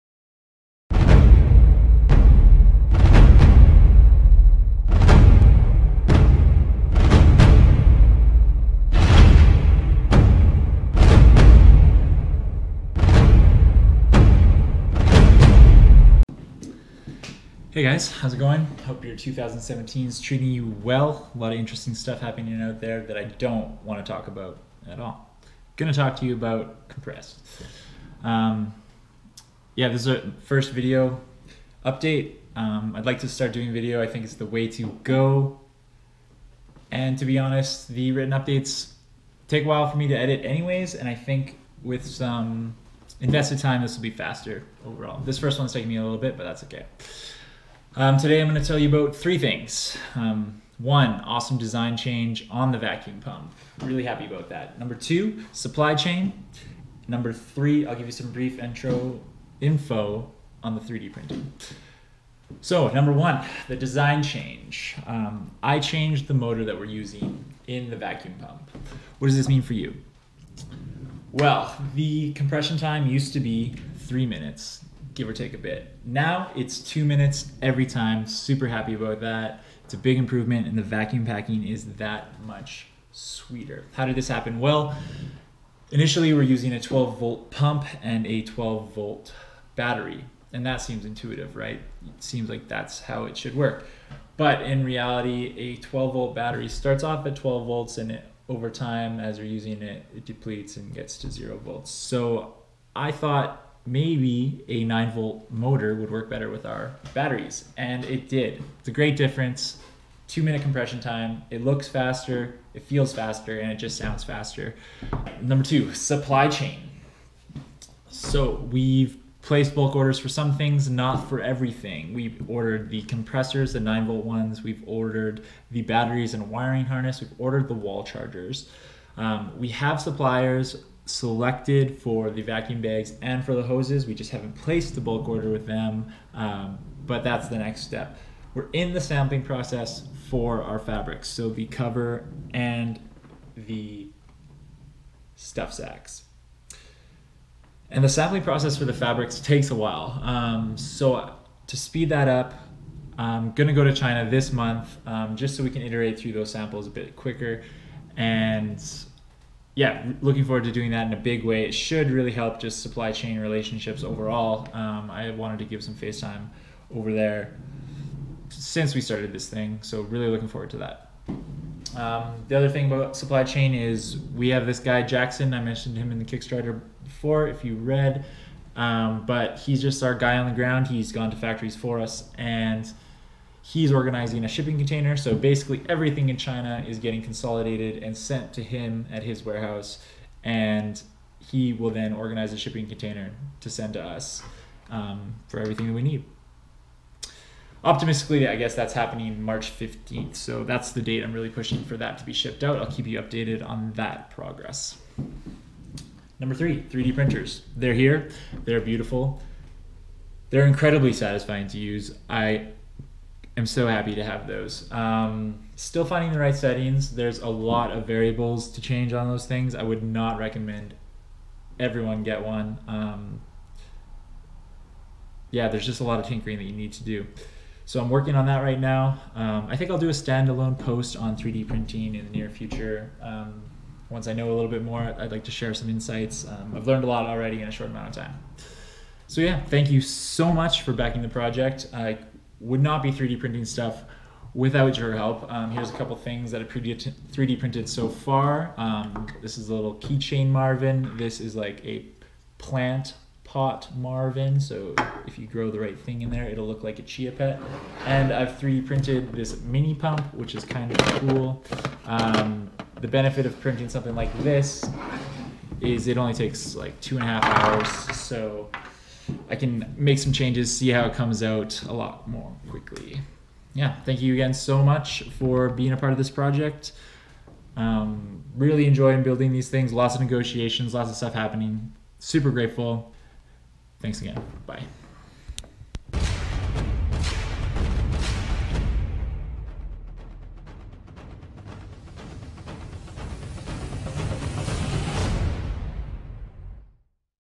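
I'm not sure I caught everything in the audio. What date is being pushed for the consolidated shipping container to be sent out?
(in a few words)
March 15th.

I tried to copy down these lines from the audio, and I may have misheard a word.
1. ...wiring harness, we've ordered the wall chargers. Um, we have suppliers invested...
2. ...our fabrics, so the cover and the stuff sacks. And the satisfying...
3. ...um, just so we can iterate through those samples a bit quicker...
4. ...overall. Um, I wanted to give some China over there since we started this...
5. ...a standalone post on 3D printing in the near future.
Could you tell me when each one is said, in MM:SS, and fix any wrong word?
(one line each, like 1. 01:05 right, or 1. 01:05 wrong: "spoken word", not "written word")
1. 02:06 wrong: "selected", not "invested"
2. 02:20 wrong: "sampling", not "satisfying"
3. 02:35 right
4. 02:44 wrong: "FaceTime", not "China"
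5. 03:50 right.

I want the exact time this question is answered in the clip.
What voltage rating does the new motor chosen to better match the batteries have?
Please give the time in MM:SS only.
01:44.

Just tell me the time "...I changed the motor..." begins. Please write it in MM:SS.
01:05.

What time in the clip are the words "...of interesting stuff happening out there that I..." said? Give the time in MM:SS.
00:21.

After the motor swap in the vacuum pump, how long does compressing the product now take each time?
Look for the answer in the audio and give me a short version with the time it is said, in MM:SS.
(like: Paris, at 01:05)
2 minutes, at 01:16.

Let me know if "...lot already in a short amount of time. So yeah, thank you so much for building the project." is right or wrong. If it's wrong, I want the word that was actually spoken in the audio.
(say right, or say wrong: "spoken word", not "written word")
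wrong: "backing", not "building".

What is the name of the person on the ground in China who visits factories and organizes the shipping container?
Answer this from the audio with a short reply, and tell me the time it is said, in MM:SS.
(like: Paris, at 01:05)
Jackson, at 02:55.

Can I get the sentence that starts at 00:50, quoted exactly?
Um, one, awesome design change on the vacuum pump.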